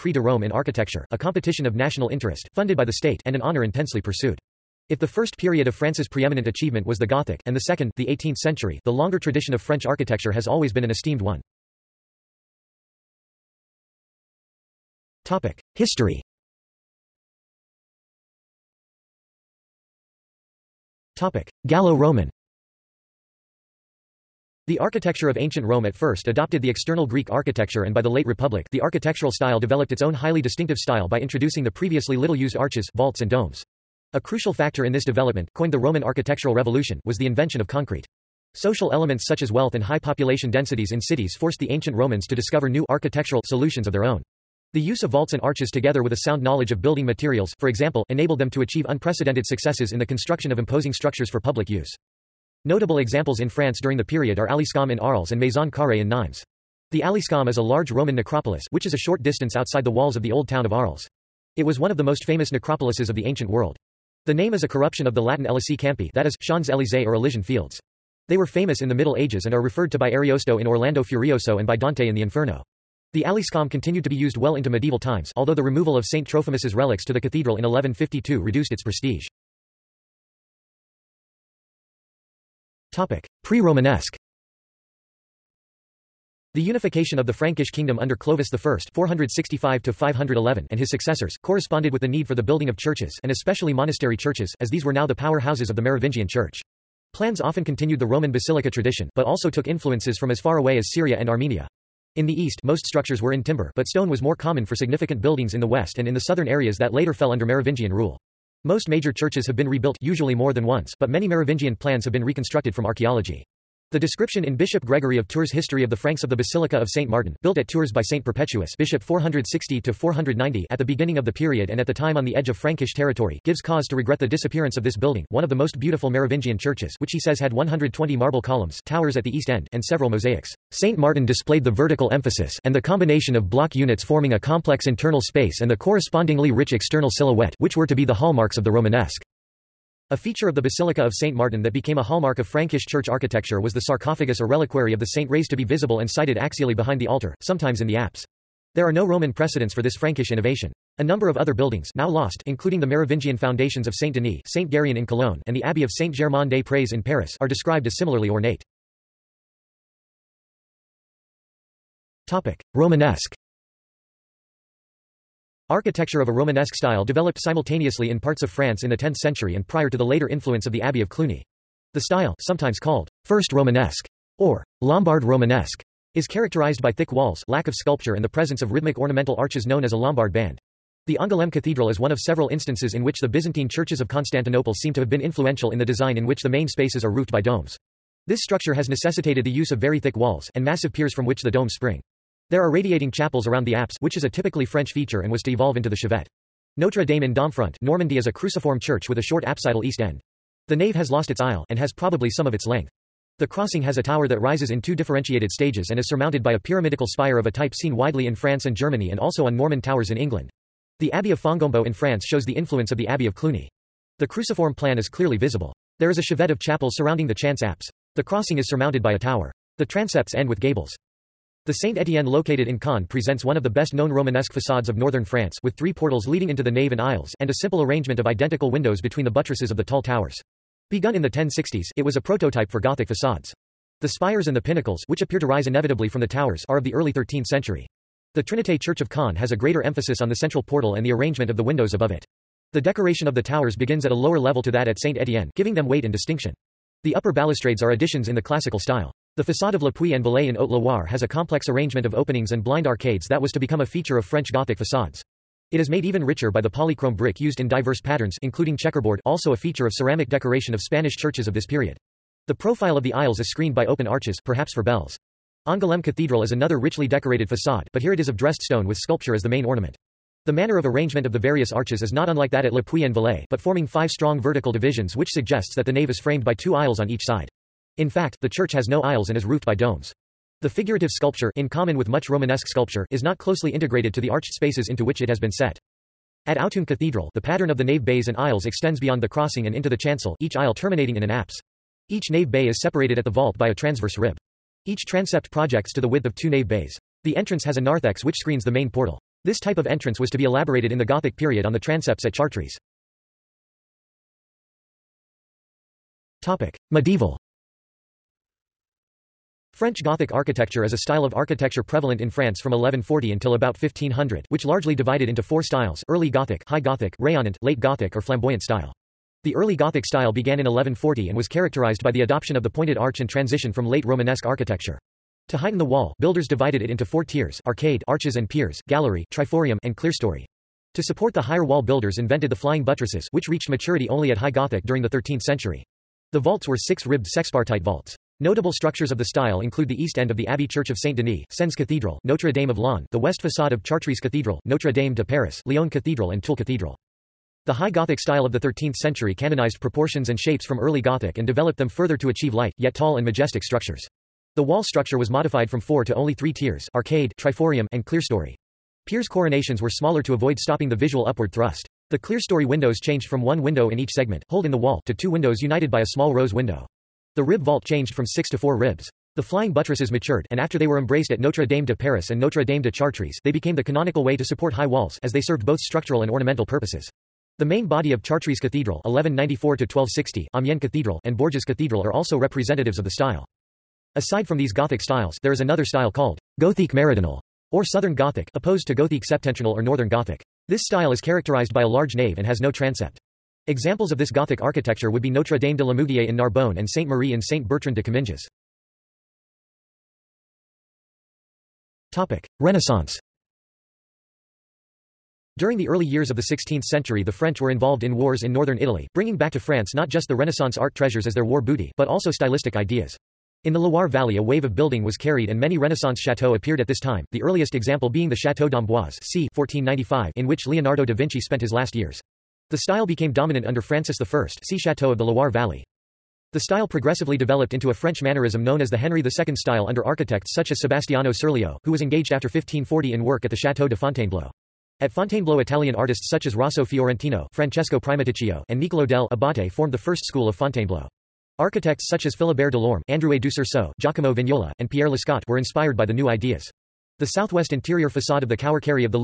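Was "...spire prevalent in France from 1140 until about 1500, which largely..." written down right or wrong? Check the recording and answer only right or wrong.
wrong.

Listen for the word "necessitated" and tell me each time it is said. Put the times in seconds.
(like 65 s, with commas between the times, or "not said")
188 s.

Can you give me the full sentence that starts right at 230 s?
Begun in the 1060s, it was a prototype for Gothic facades.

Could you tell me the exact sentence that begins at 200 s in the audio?
The nave has lost its aisle, and has probably some of its length.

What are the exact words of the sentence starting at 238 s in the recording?
The Trinité Church of Caen has a greater emphasis on the central portal and the arrangement of the windows above it.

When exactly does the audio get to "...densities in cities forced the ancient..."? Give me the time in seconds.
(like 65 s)
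40 s.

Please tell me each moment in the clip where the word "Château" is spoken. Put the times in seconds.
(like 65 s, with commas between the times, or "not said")
418 s, 433 s.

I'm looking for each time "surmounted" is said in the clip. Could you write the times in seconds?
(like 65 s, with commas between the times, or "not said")
206 s, 218 s.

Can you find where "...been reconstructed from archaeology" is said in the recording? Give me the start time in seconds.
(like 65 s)
112 s.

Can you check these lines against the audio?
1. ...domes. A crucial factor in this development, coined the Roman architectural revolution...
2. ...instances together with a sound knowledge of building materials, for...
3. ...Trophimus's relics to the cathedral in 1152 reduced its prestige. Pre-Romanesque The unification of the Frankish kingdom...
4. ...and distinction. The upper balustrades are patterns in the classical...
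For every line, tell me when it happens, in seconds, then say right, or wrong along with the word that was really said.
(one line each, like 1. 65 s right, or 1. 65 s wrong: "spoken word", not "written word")
1. 33 s right
2. 45 s wrong: "arches", not "instances"
3. 76 s right
4. 246 s wrong: "additions", not "patterns".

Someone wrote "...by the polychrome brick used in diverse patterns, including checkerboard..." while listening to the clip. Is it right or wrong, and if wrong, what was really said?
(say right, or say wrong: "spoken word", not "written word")
right.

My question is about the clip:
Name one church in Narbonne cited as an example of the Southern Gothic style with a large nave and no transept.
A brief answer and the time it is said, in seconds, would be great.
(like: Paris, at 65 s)
Notre Dame de Lamourguier, at 395 s.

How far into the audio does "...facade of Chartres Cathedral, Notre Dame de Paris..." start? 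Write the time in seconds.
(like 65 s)
343 s.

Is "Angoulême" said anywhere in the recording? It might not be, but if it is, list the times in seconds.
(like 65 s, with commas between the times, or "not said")
181 s, 265 s.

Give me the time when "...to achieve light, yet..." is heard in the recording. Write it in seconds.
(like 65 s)
352 s.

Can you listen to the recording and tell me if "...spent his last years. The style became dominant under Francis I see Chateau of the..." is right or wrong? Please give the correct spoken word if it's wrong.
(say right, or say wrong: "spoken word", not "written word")
right.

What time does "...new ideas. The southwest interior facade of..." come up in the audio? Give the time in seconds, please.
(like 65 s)
446 s.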